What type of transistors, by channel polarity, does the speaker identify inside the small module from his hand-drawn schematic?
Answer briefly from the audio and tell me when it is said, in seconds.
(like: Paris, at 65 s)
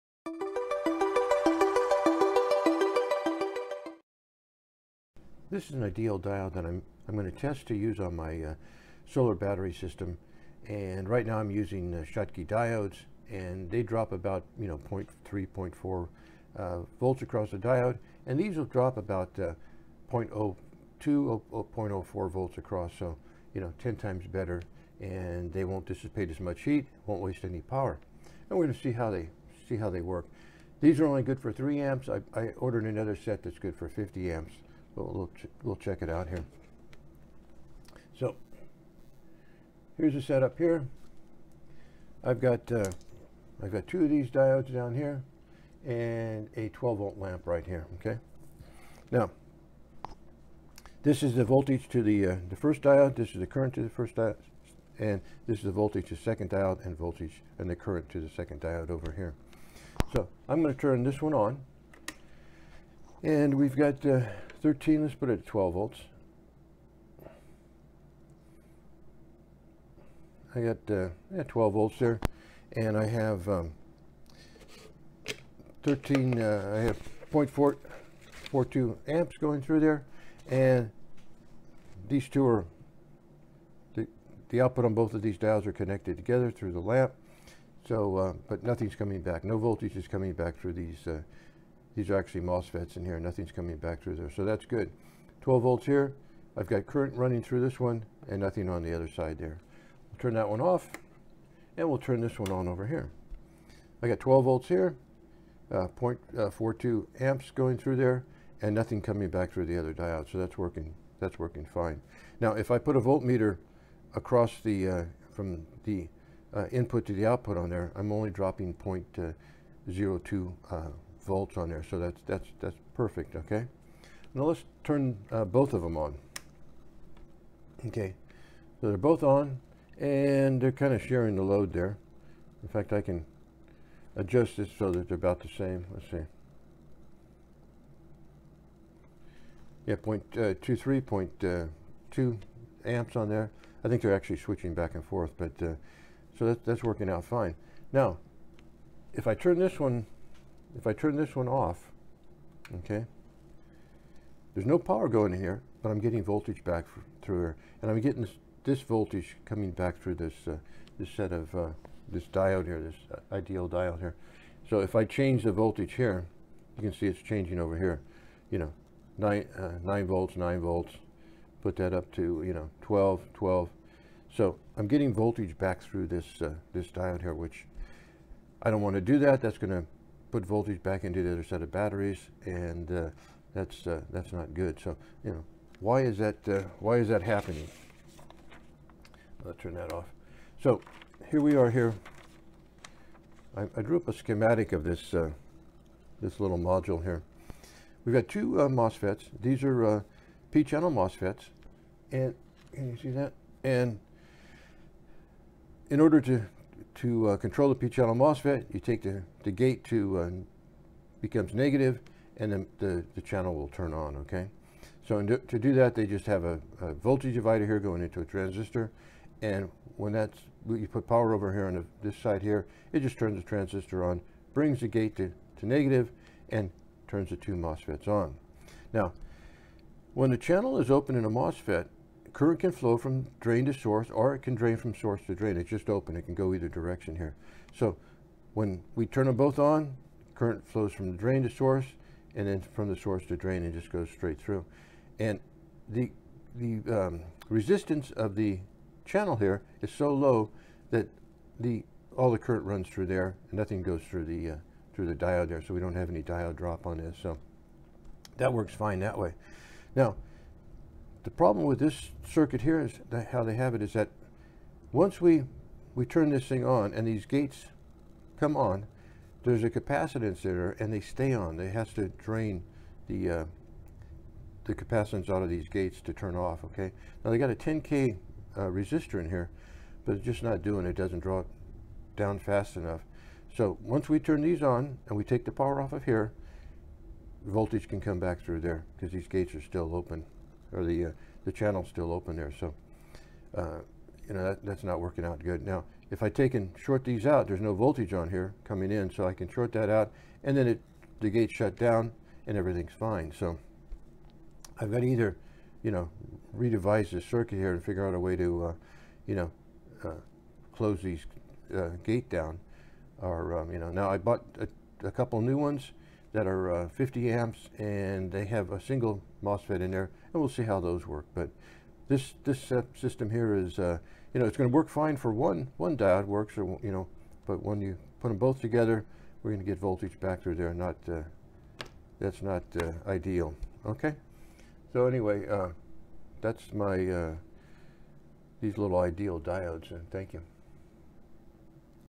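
P-channel MOSFETs, at 200 s.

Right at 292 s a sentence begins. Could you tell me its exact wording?
So, uh, you know, that, that's not working out good.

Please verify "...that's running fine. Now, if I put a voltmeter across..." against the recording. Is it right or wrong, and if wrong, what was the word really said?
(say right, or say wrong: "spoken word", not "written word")
wrong: "working", not "running".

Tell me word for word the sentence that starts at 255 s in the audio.
So we don't have any diode drop on this.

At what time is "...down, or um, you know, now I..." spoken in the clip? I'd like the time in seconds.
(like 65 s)
312 s.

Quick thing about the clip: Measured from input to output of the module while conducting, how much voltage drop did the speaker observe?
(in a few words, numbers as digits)
0.02 volts.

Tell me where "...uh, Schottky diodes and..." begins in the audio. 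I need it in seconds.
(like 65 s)
11 s.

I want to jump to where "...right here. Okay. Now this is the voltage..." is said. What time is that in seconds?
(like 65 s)
47 s.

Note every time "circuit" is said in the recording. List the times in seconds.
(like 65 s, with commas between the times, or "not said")
262 s, 307 s.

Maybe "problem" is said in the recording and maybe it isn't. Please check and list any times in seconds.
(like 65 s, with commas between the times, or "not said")
261 s.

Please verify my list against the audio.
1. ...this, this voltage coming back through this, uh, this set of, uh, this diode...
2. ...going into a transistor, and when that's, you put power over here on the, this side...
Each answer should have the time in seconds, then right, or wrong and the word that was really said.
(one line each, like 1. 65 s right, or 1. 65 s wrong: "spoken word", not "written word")
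1. 158 s right
2. 217 s right.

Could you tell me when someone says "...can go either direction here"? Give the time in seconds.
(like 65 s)
236 s.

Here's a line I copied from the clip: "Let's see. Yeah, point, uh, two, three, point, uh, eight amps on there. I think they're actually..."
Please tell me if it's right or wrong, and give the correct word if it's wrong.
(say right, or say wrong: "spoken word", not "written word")
wrong: "two", not "eight".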